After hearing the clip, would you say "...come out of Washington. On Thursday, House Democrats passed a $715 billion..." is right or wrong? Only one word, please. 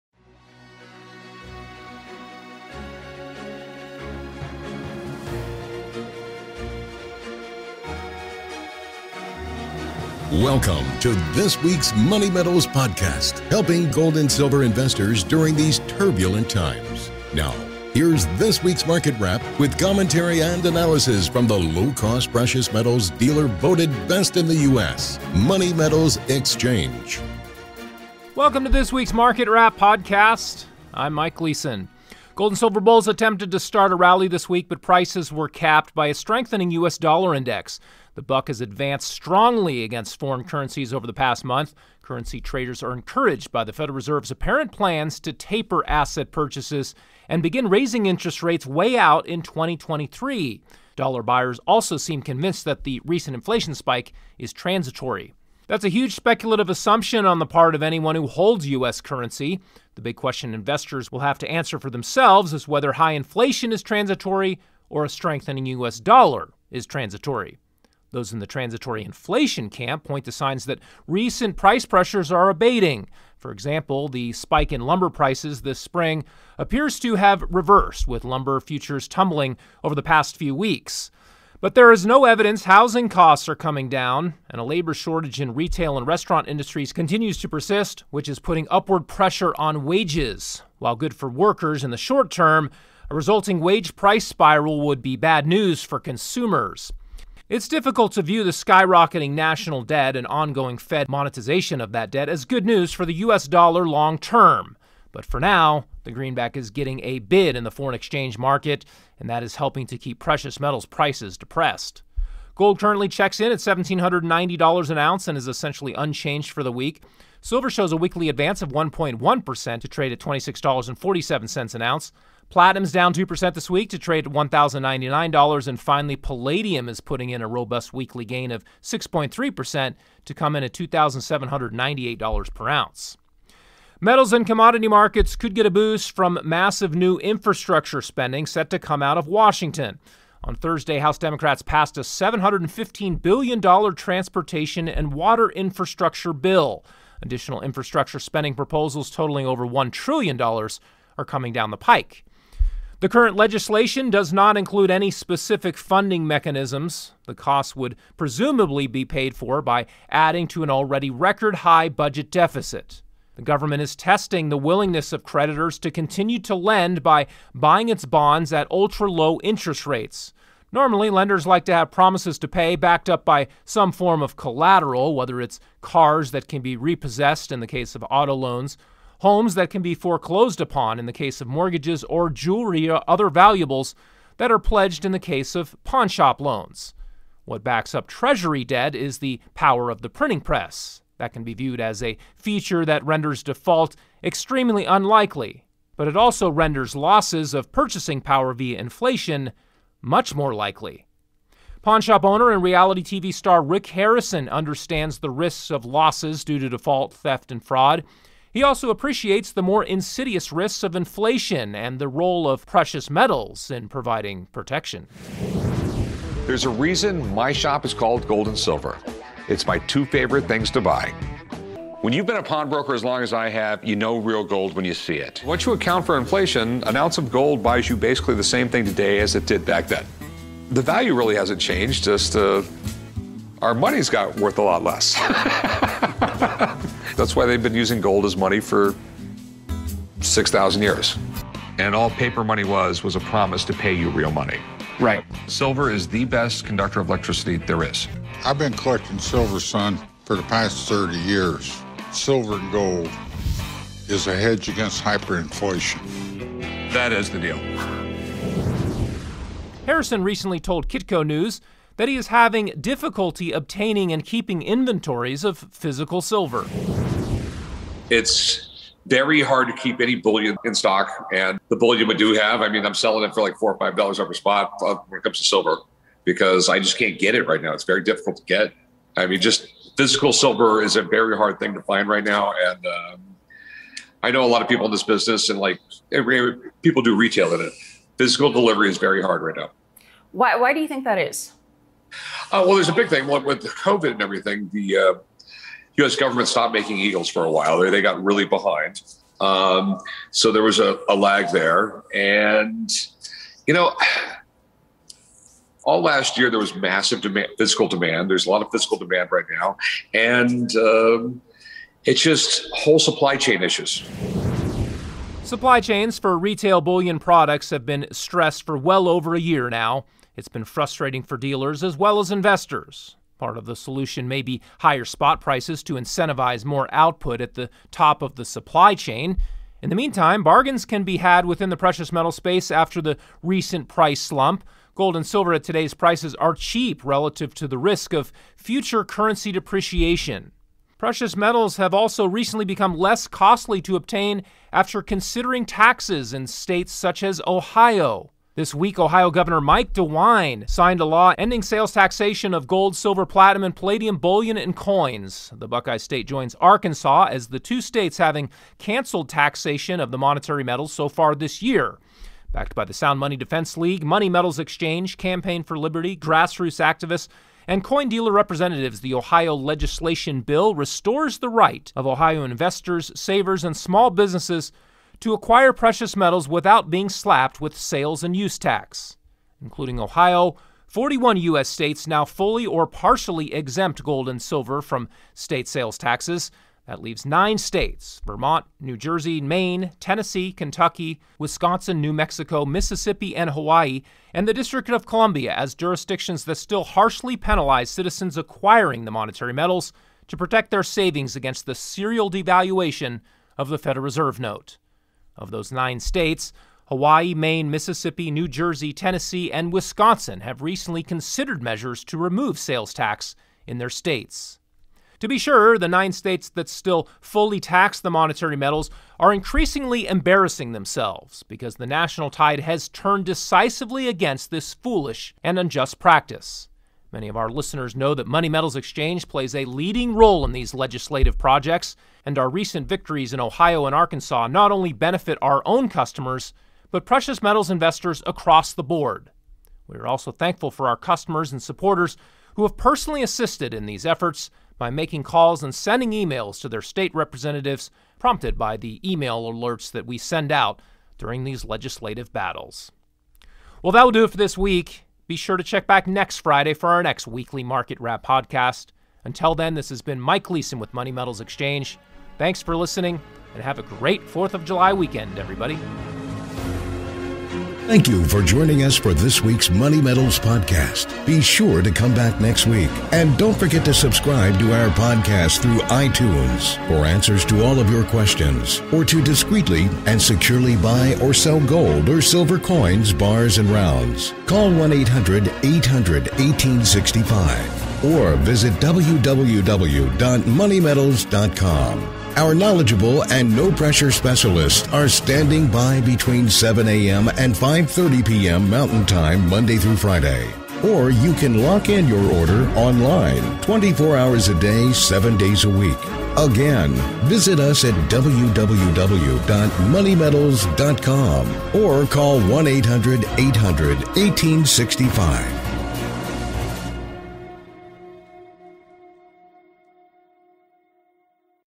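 right.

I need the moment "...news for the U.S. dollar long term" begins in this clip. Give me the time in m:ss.
1:42.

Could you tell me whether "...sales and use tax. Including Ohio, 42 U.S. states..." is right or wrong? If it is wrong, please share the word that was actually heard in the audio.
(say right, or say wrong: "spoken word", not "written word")
wrong: "41", not "42".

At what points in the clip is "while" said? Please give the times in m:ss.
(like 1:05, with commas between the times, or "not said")
1:30, 4:57.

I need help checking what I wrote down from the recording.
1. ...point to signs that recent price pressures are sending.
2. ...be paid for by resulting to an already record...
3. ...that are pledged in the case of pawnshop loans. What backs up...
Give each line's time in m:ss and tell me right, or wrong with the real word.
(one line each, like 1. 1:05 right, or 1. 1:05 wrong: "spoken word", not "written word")
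1. 1:10 wrong: "abating", not "sending"
2. 2:38 wrong: "adding", not "resulting"
3. 3:04 right.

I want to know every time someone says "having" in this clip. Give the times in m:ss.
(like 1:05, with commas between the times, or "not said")
4:22, 5:58.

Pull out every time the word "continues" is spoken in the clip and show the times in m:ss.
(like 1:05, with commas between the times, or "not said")
1:26, 2:45.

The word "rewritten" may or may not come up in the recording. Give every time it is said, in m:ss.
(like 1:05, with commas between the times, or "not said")
not said.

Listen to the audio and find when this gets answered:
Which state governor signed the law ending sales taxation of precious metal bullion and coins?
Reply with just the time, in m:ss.
5:49.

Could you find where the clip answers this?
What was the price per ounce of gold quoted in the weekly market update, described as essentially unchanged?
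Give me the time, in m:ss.
1:53.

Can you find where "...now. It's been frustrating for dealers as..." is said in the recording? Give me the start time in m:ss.
5:19.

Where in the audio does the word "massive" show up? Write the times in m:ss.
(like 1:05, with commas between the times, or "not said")
2:16, 5:06.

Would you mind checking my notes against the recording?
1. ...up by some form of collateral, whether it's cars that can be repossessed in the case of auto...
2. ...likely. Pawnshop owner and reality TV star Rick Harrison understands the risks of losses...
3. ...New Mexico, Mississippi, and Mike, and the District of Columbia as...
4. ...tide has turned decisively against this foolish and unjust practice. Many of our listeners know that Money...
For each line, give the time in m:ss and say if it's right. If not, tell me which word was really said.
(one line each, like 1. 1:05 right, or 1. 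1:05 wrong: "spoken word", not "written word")
1. 2:53 right
2. 3:20 right
3. 6:32 wrong: "Hawaii", not "Mike"
4. 7:02 right.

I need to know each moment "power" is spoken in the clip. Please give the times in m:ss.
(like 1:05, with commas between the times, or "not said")
3:09, 3:18.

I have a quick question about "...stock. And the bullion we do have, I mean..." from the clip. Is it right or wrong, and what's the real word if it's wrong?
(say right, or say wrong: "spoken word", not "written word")
right.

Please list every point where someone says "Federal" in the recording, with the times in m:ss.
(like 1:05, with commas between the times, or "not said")
0:43, 6:43.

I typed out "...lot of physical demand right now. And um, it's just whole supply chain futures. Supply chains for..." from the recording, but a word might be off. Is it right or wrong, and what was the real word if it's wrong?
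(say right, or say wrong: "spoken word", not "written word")
wrong: "issues", not "futures".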